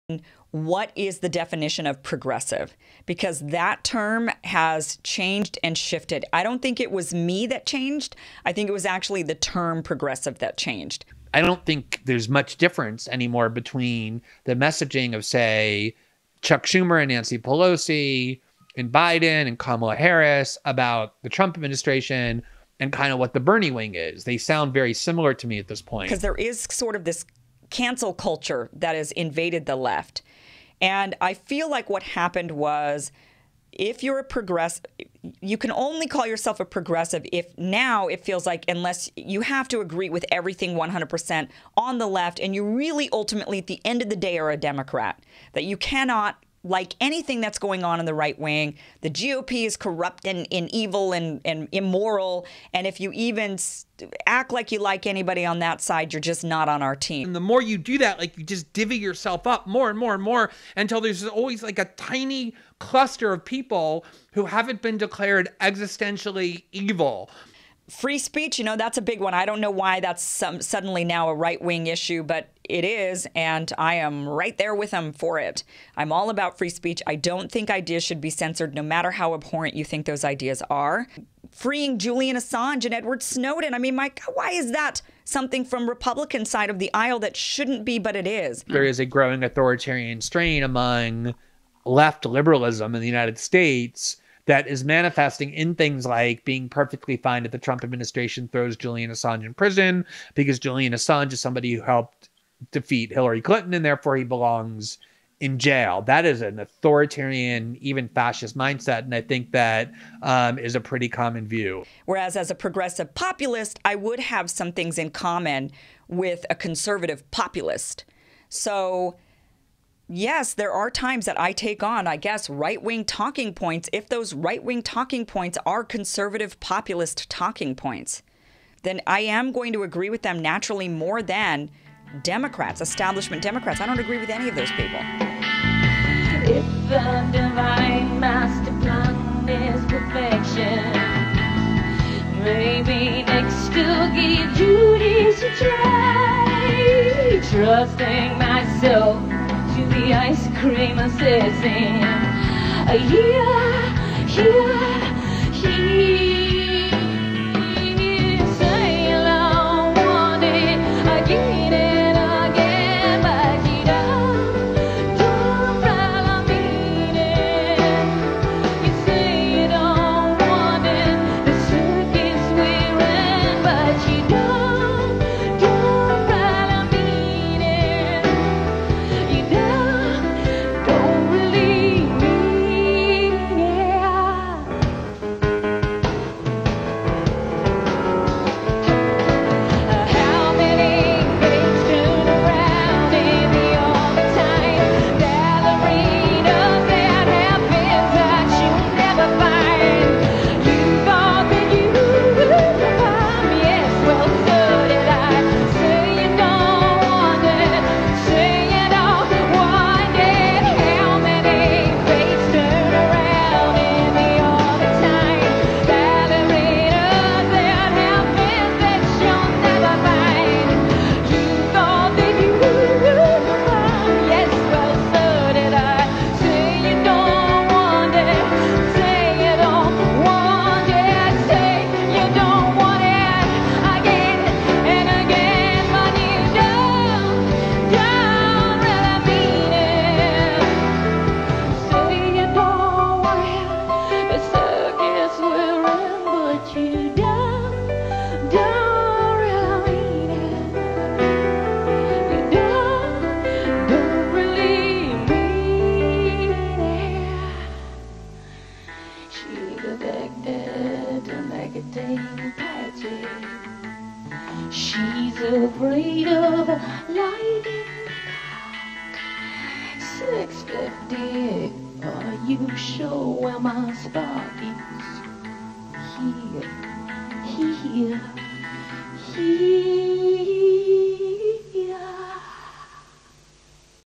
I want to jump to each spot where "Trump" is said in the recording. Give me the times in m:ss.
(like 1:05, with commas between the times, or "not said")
0:21, 1:37.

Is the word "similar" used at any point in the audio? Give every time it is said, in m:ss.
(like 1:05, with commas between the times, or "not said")
0:24.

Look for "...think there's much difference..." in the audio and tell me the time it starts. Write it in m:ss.
0:11.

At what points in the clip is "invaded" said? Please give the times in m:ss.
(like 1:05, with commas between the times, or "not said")
0:29.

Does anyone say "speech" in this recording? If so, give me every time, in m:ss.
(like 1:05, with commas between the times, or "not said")
1:08, 1:16.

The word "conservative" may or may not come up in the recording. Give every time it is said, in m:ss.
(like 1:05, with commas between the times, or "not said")
1:56, 2:05.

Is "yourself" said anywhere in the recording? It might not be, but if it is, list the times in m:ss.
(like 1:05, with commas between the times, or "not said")
0:36, 0:58.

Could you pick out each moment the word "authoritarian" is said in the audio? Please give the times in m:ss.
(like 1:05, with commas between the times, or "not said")
1:29, 1:46.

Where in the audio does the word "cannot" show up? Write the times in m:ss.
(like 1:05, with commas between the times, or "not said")
0:45.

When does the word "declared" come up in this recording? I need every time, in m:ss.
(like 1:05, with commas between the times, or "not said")
1:04.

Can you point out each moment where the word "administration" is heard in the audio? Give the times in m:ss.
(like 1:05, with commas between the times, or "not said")
0:21, 1:37.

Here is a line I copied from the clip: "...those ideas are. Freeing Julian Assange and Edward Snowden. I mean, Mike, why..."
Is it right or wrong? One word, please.
right.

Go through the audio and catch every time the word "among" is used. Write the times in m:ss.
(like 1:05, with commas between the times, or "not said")
1:30.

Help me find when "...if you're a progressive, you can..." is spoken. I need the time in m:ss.
0:33.